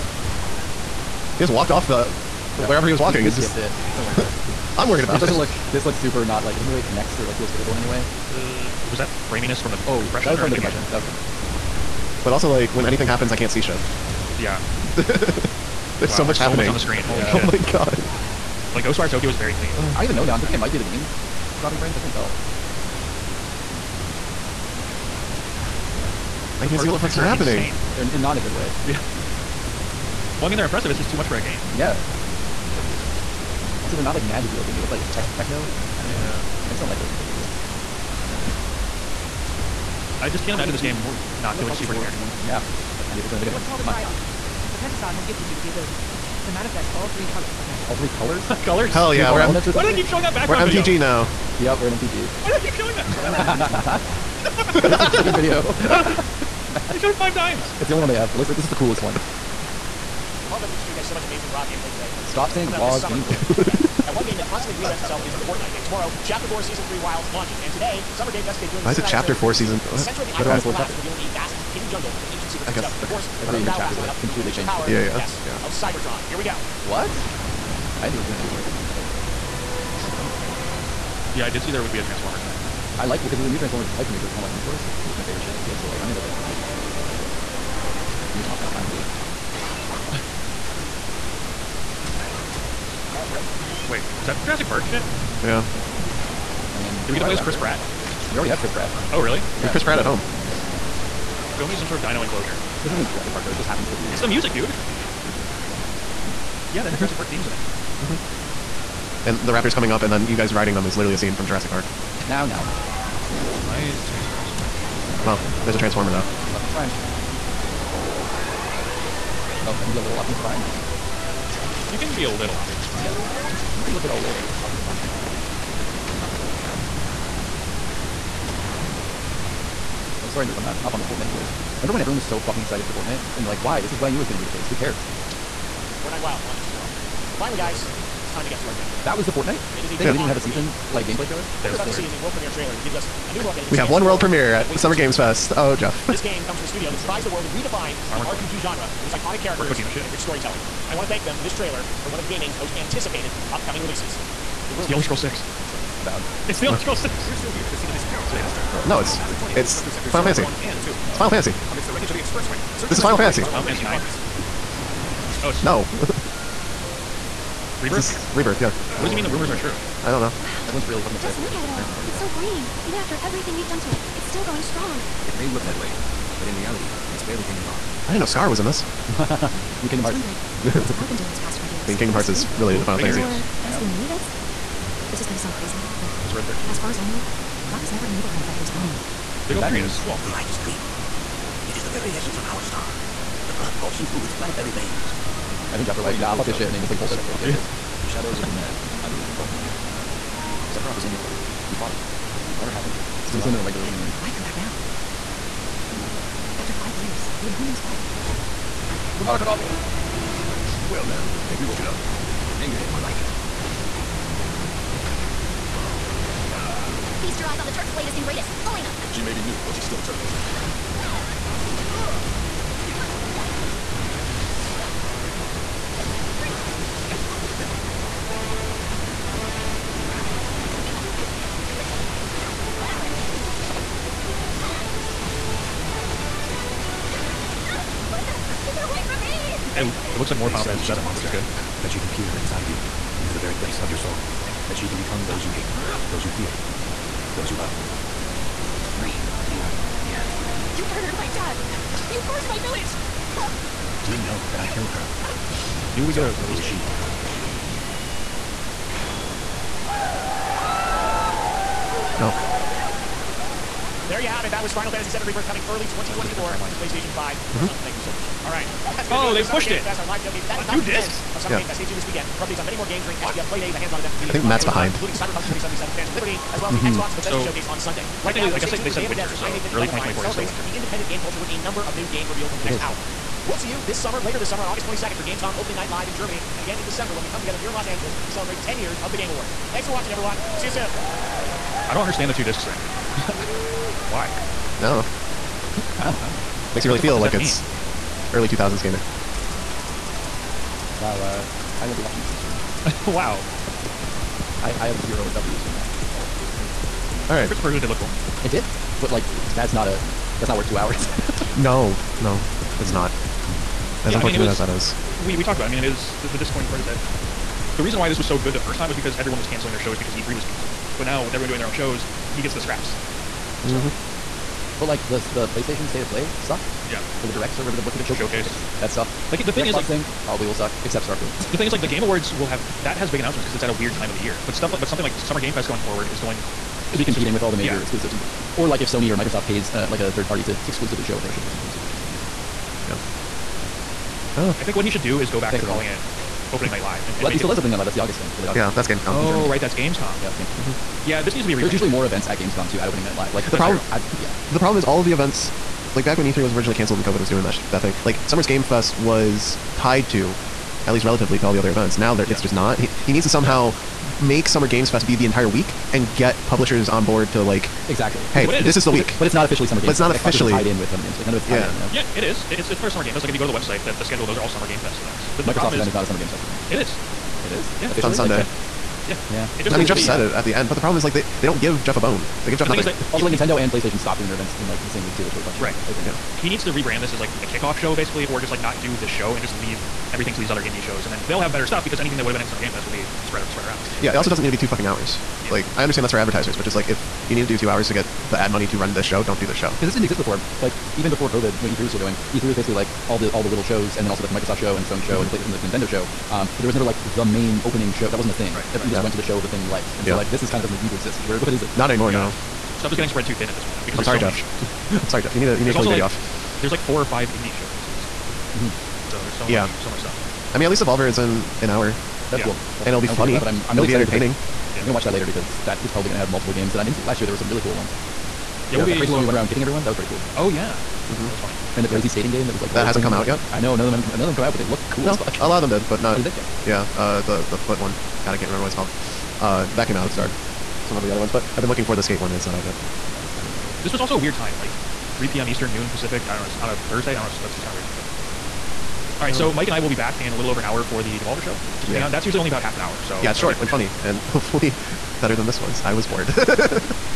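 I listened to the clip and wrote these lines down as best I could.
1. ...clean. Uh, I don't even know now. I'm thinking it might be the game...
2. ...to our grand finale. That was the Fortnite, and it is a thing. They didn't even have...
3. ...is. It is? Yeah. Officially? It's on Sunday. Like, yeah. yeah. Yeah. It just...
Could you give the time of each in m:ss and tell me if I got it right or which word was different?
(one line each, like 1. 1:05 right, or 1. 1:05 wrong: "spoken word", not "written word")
1. 0:19 right
2. 2:18 right
3. 6:16 right.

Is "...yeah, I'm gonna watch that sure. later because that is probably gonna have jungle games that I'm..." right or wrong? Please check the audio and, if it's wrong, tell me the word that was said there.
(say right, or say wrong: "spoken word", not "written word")
wrong: "multiple", not "jungle".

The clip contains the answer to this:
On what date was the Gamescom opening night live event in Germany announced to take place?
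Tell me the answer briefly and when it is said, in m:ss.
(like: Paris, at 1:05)
August 22nd, at 4:44.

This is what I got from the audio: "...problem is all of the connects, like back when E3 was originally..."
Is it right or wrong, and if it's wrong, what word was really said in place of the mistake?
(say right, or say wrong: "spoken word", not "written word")
wrong: "events", not "connects".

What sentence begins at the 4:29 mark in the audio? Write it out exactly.
Fest, our live showcase, but that On is not the discs?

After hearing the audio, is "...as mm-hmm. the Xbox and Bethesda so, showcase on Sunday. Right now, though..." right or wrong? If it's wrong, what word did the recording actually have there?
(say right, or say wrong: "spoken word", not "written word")
right.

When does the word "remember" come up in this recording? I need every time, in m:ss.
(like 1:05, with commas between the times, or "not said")
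2:11, 7:18.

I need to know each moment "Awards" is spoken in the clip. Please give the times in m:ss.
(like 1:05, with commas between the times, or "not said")
4:49, 5:32.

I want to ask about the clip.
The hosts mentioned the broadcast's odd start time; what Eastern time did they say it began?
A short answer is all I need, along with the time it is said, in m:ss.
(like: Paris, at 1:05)
3 p.m., at 7:25.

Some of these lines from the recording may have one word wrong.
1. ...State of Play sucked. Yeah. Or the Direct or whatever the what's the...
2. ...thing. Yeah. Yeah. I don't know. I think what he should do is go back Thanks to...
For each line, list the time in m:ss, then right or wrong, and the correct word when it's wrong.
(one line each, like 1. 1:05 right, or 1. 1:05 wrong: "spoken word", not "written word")
1. 5:25 right
2. 5:42 right.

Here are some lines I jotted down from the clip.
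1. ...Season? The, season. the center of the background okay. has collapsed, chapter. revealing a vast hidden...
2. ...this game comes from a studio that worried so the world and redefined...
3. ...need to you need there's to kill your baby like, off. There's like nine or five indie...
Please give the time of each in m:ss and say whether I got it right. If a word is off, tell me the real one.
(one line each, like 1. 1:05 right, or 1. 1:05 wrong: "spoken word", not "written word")
1. 1:09 wrong: "island", not "background"
2. 2:26 wrong: "surprised", not "worried"
3. 6:55 wrong: "four", not "nine".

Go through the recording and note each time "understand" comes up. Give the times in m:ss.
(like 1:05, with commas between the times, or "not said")
4:52, 6:35.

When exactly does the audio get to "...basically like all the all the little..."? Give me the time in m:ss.
6:42.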